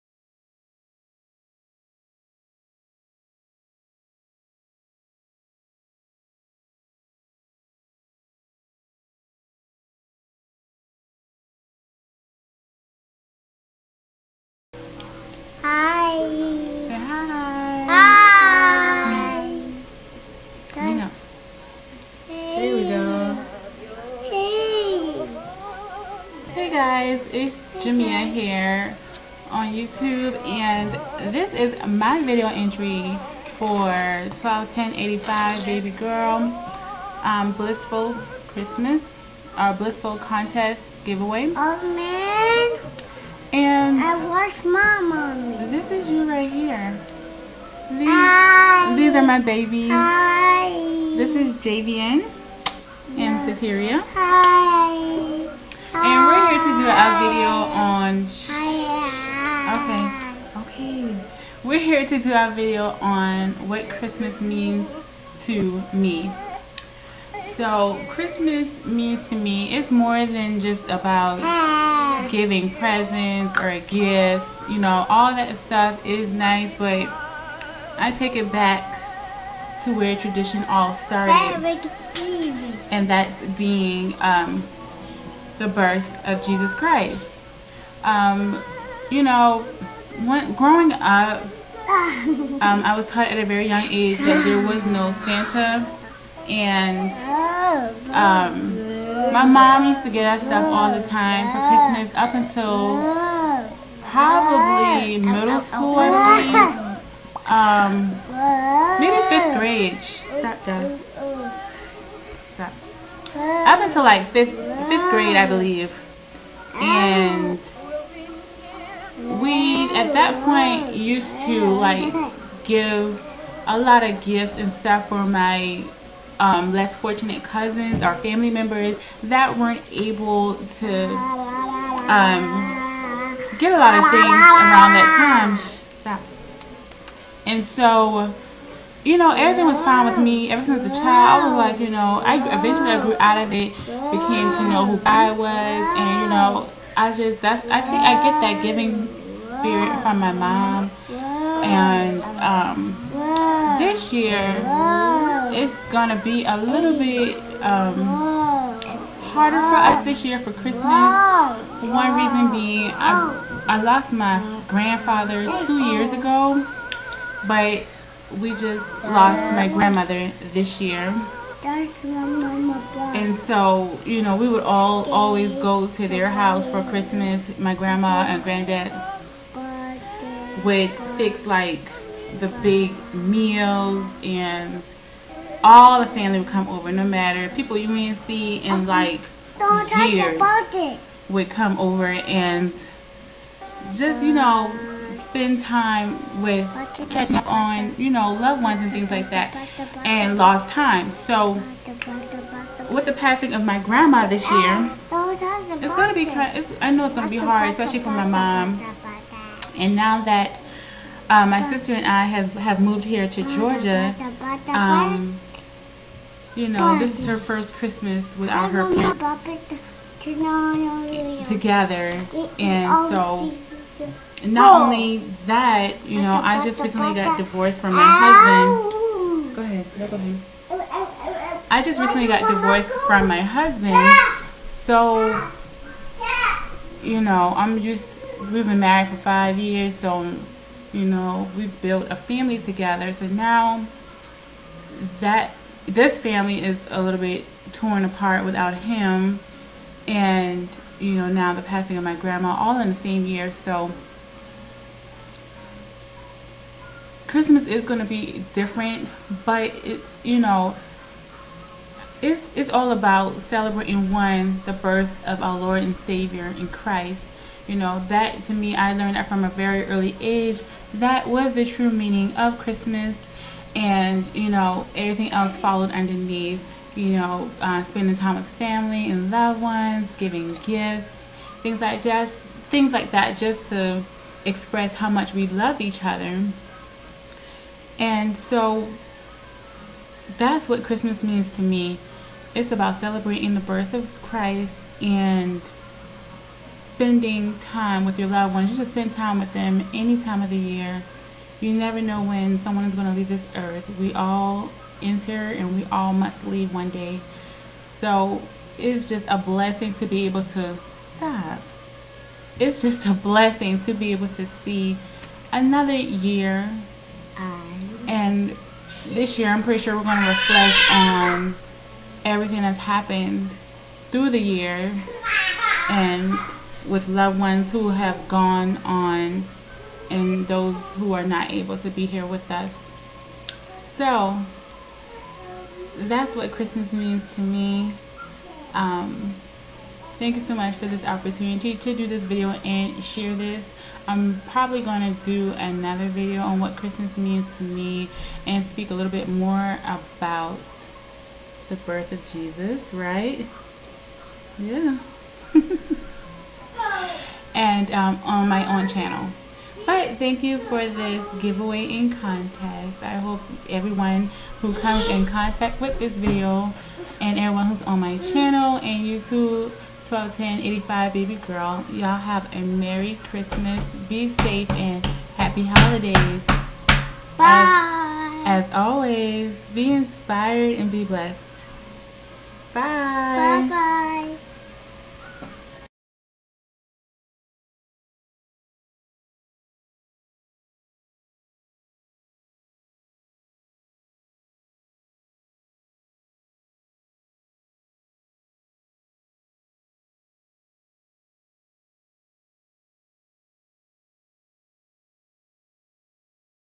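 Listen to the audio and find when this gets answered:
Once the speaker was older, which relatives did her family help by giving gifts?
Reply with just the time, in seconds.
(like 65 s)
126 s.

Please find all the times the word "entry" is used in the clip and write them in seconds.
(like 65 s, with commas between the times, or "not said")
32 s.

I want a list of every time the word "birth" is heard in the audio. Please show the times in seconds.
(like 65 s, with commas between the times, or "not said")
85 s, 264 s, 293 s, 351 s.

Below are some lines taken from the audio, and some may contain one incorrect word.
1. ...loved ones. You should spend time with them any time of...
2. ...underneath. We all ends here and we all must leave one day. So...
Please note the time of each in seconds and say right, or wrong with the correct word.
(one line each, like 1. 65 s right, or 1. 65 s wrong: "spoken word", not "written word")
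1. 298 s right
2. 303 s wrong: "earth", not "underneath".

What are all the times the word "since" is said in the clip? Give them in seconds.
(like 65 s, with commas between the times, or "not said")
140 s.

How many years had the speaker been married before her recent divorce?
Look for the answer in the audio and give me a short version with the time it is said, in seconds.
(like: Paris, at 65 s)
5 years, at 239 s.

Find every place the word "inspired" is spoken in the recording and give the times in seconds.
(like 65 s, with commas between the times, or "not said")
379 s.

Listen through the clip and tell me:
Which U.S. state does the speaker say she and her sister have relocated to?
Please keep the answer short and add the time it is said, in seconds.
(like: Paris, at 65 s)
Georgia, at 213 s.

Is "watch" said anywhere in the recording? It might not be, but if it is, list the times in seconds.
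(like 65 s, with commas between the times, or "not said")
44 s.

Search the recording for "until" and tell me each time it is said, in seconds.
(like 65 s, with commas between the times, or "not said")
102 s, 113 s.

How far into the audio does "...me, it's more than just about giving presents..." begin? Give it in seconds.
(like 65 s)
69 s.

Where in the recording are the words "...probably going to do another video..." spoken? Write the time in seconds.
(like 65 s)
344 s.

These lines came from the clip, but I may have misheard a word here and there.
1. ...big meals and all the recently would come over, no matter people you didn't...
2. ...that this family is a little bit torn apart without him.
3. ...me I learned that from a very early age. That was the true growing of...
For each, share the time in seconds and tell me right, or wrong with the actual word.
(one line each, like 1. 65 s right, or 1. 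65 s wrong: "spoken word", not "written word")
1. 182 s wrong: "family", not "recently"
2. 245 s right
3. 268 s wrong: "meaning", not "growing".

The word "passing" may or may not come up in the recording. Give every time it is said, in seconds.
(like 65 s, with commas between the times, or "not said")
203 s, 251 s.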